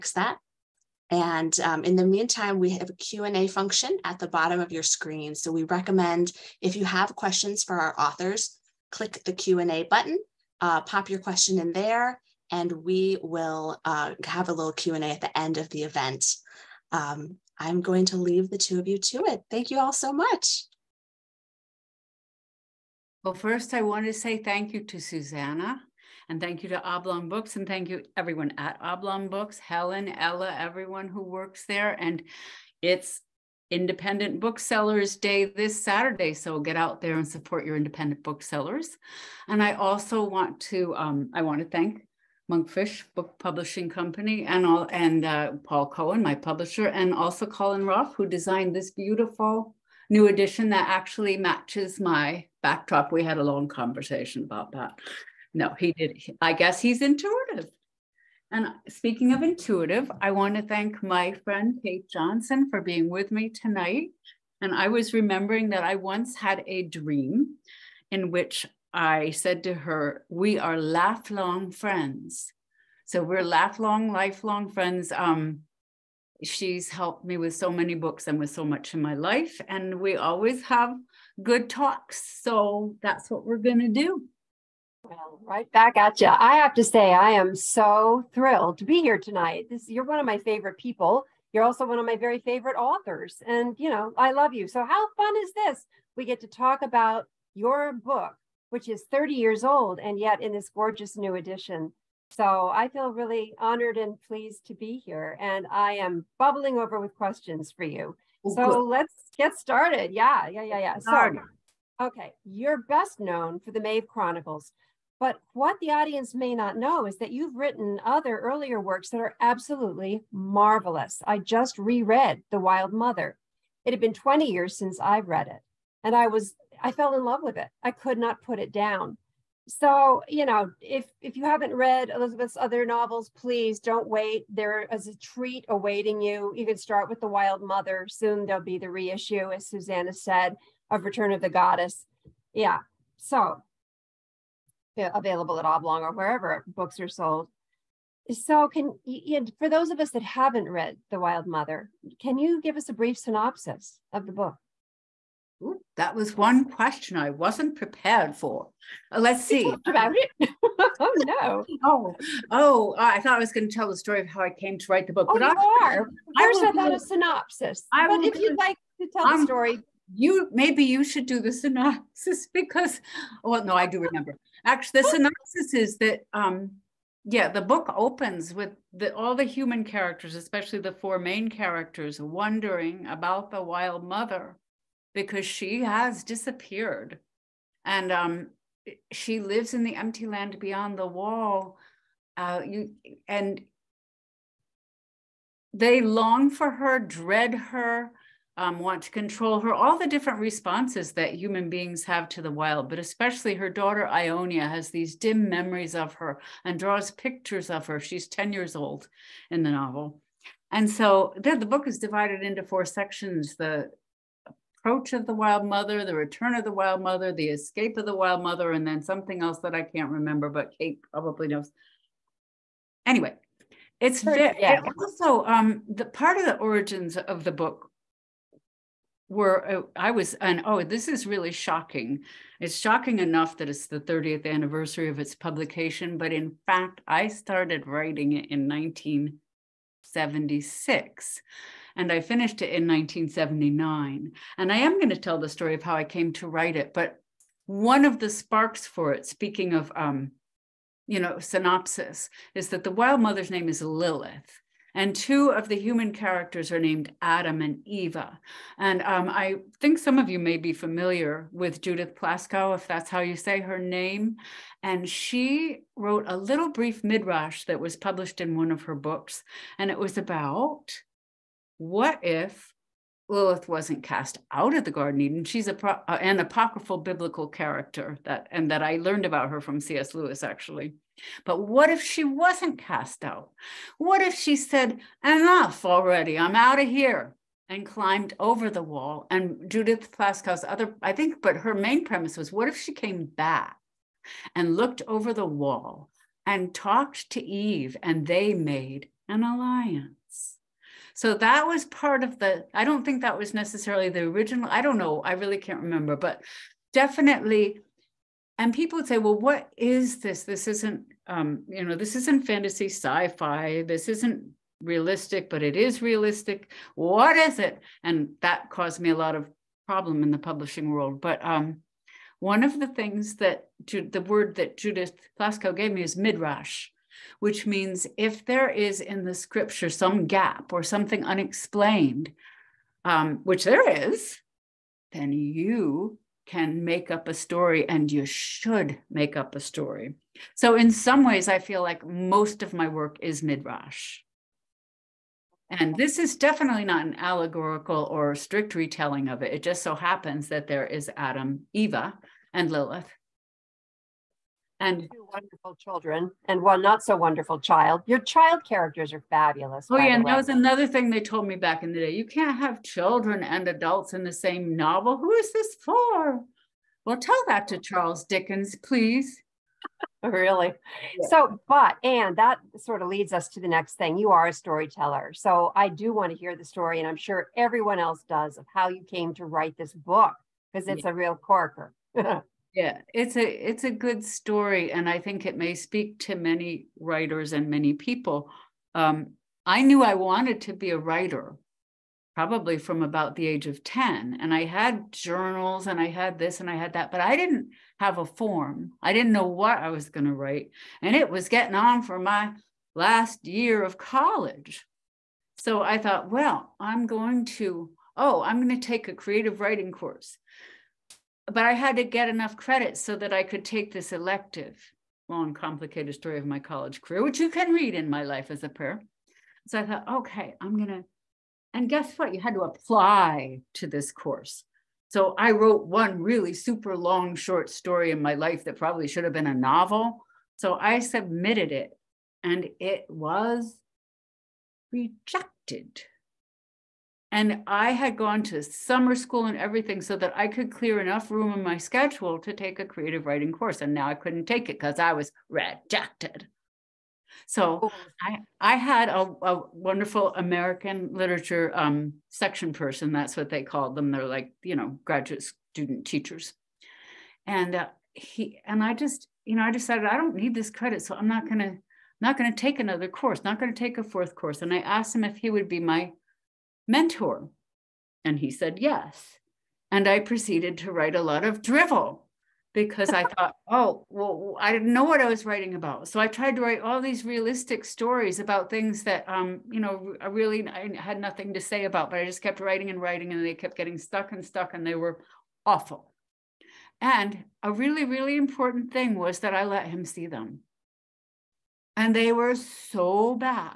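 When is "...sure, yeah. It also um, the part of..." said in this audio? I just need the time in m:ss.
3:44.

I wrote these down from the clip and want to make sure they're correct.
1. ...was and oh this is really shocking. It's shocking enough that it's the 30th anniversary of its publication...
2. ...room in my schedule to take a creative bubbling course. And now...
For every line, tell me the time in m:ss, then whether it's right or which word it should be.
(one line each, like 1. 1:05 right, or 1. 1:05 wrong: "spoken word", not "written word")
1. 3:50 right
2. 7:21 wrong: "writing", not "bubbling".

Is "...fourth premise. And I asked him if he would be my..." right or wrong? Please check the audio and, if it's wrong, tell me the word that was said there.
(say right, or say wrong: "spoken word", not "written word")
wrong: "course", not "premise".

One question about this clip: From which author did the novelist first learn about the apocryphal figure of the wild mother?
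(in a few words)
C.S. Lewis.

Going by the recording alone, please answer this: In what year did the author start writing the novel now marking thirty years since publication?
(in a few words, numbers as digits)
1976.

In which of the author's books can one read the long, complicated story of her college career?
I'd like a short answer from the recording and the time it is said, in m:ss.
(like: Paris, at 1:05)
My Life as a Prayer, at 6:58.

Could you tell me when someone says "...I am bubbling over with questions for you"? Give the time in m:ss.
1:45.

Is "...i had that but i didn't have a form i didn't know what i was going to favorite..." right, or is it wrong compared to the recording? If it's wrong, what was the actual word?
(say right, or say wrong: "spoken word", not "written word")
wrong: "write", not "favorite".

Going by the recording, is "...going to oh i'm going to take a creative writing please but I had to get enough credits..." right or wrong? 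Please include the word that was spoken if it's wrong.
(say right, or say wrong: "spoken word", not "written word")
wrong: "course", not "please".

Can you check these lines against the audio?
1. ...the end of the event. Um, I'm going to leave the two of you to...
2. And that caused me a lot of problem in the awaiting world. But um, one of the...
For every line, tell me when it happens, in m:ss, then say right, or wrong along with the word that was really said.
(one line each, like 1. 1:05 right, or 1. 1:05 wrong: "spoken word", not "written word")
1. 0:15 right
2. 5:18 wrong: "publishing", not "awaiting".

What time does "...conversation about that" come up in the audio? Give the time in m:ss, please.
0:53.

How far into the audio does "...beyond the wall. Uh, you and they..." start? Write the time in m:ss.
3:10.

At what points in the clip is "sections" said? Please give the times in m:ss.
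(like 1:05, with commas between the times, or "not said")
3:32, 7:32.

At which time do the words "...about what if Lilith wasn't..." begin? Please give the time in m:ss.
4:30.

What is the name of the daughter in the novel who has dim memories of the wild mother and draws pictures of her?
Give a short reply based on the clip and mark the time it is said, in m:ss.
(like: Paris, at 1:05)
Ionia, at 3:24.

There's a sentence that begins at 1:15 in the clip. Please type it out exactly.
Um, she's helped me with so many books and with so much in my life.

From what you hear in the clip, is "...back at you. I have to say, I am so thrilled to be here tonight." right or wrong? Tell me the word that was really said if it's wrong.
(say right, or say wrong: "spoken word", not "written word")
right.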